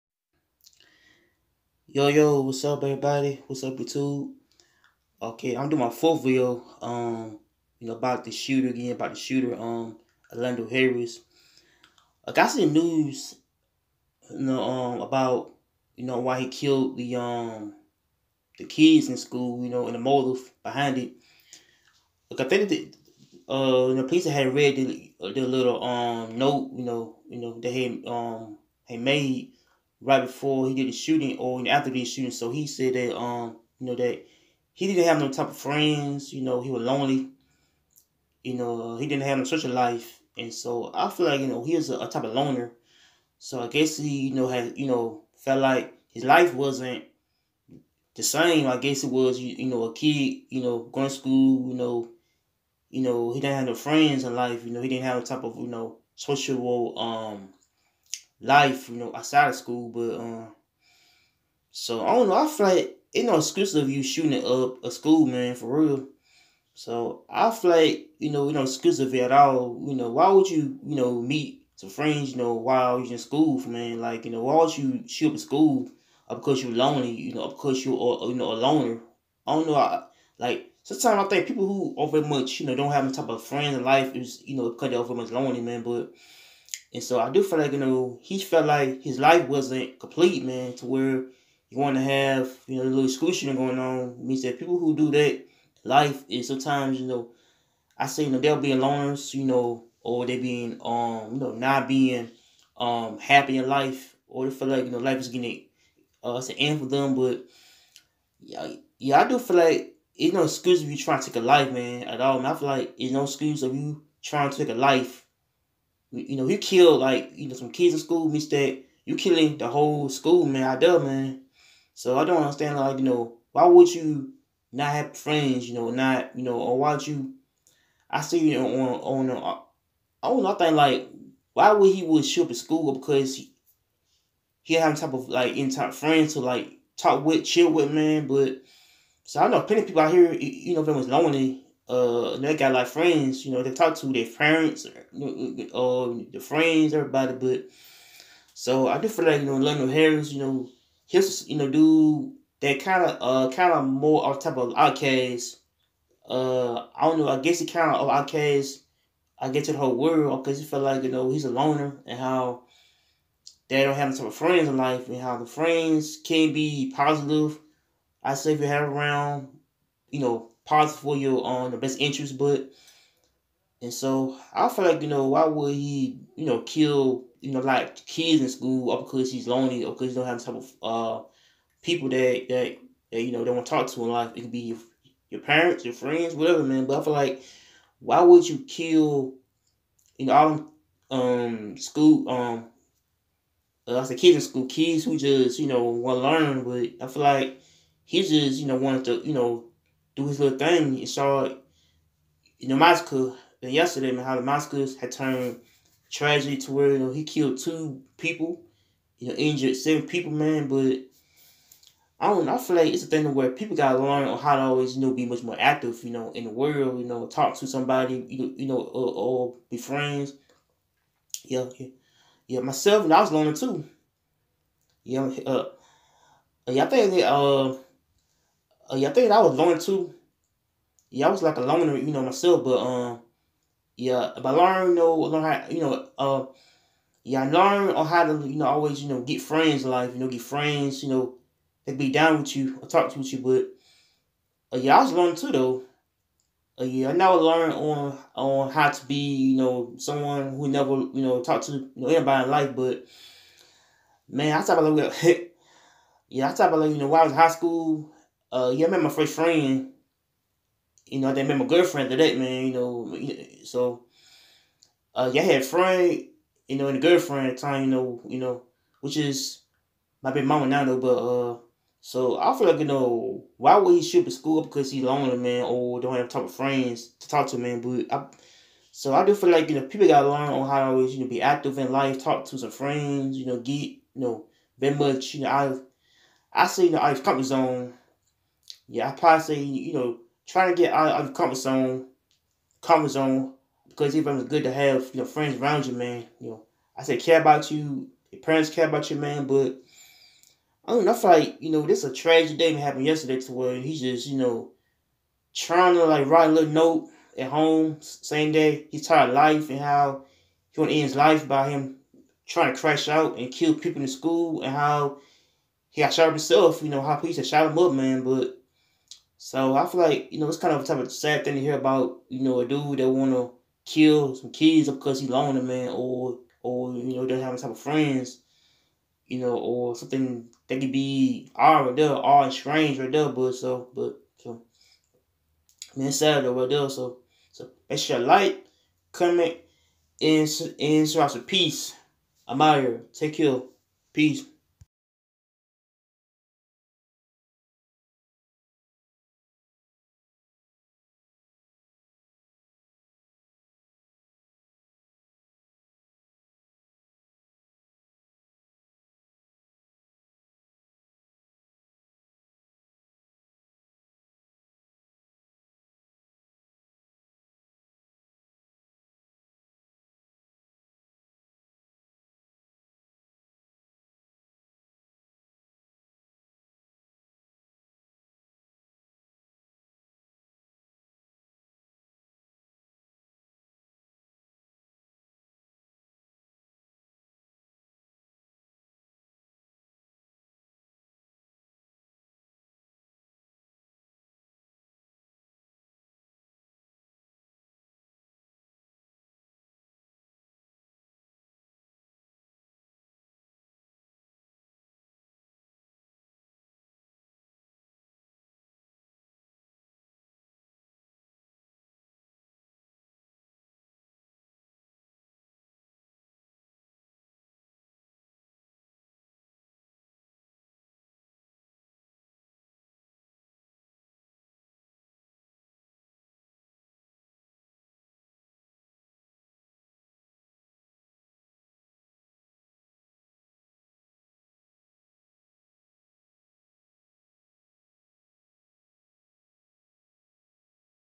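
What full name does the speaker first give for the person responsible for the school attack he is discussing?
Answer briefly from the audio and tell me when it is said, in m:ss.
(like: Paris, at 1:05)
Orlando Harris, at 0:10.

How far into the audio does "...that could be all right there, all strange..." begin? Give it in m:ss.
5:30.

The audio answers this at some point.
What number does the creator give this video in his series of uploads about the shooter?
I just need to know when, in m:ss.
0:05.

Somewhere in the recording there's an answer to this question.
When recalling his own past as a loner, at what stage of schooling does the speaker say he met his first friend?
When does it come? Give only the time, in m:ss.
4:17.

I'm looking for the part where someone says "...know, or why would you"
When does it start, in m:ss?
2:06.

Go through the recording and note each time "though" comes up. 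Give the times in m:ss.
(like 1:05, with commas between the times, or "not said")
4:05, 4:30.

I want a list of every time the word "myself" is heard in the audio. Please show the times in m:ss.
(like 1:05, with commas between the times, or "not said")
3:42, 3:52.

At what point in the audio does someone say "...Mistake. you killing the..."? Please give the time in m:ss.
1:58.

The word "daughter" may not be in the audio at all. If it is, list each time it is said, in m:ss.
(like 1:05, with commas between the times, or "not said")
not said.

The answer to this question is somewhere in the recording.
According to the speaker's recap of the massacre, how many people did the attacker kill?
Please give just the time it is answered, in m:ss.
3:27.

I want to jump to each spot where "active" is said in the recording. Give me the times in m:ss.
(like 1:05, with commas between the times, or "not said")
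3:35, 4:41.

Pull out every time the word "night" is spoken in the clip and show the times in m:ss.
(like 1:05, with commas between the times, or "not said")
not said.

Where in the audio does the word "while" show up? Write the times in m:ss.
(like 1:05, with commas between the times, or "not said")
1:12, 4:17.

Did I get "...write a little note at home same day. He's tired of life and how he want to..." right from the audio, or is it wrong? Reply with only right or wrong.
right.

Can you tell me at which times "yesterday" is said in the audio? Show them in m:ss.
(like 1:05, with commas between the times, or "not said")
3:23, 5:03.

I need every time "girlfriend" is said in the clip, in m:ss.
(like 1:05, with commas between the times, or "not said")
4:21, 4:27.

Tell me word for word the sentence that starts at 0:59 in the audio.
But um, so I don't know.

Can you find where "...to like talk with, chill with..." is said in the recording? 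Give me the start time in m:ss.
2:16.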